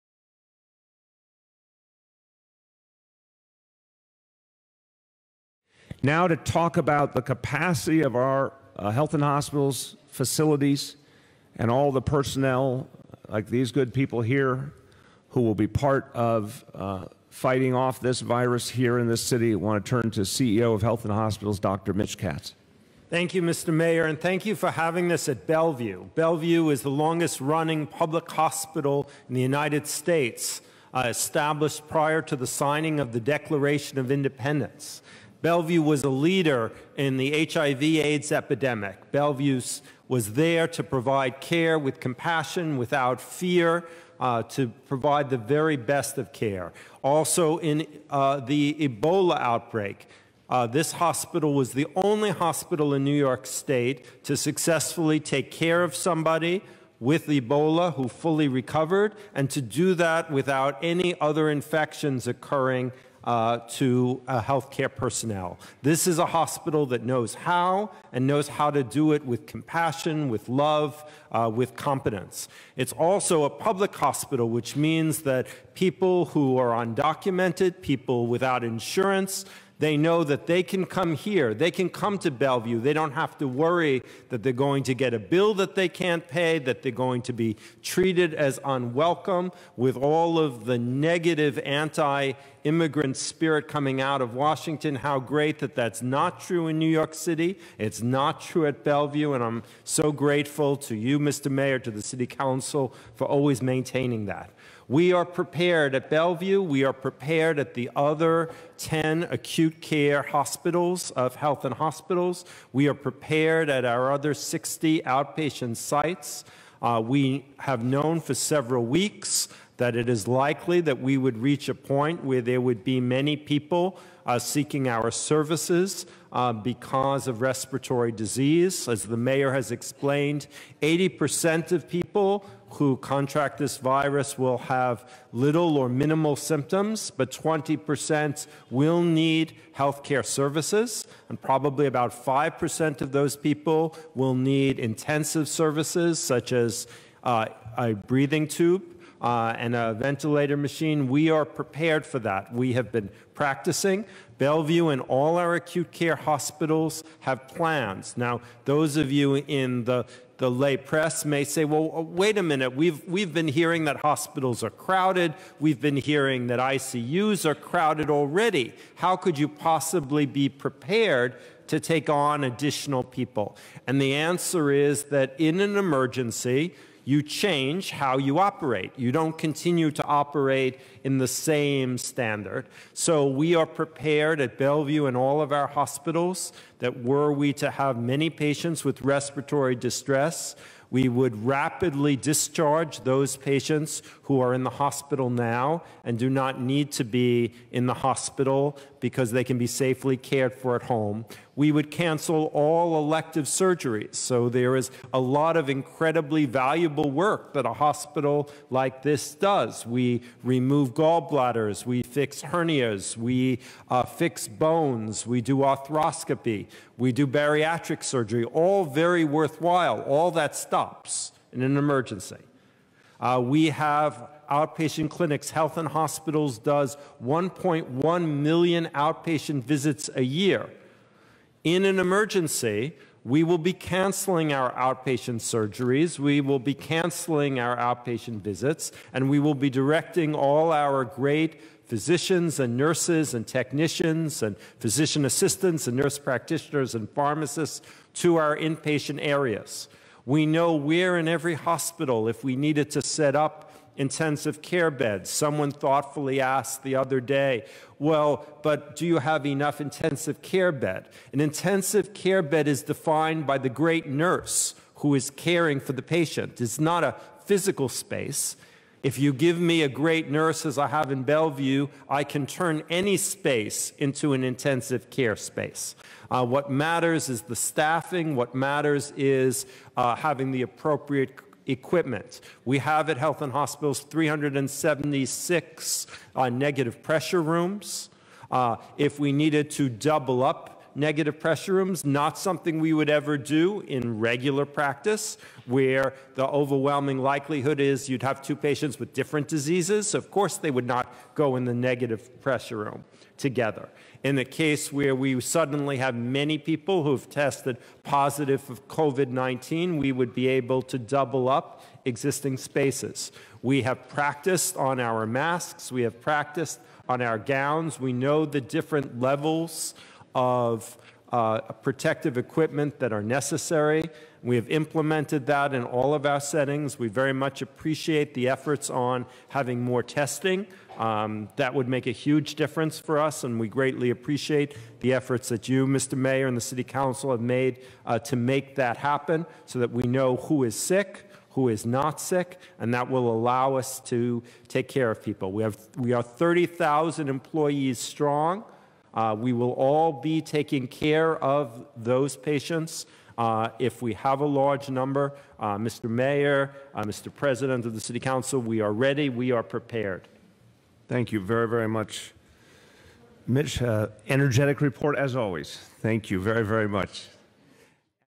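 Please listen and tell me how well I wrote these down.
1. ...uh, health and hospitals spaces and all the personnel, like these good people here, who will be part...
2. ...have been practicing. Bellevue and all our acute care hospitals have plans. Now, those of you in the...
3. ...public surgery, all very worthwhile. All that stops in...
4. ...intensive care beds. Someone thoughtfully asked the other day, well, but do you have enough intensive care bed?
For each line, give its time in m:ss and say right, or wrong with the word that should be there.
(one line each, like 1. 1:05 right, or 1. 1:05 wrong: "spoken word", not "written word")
1. 0:08 wrong: "facilities", not "spaces"
2. 2:32 right
3. 3:37 wrong: "bariatric", not "public"
4. 4:13 right.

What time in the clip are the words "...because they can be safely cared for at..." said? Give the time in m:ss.
3:18.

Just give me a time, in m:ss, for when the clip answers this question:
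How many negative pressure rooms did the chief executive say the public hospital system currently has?
4:44.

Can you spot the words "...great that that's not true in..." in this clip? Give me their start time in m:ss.
1:35.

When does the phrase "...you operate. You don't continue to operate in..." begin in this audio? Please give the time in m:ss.
2:58.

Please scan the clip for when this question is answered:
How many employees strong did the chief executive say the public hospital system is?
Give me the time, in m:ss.
5:46.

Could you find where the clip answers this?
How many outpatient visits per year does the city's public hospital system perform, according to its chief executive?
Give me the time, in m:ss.
3:47.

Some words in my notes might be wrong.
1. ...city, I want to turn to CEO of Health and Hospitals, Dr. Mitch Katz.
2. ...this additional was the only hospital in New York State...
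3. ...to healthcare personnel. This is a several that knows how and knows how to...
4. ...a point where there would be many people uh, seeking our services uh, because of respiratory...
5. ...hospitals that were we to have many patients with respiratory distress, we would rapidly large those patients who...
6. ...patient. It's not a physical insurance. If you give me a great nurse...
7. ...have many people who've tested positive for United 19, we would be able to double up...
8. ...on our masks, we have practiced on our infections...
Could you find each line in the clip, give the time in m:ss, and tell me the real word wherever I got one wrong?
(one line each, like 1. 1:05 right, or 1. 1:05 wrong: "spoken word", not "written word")
1. 0:19 right
2. 0:50 wrong: "hospital", not "additional"
3. 1:03 wrong: "hospital", not "several"
4. 2:01 right
5. 3:05 wrong: "discharge", not "large"
6. 4:26 wrong: "space", not "insurance"
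7. 5:05 wrong: "COVID", not "United"
8. 5:14 wrong: "gowns", not "infections".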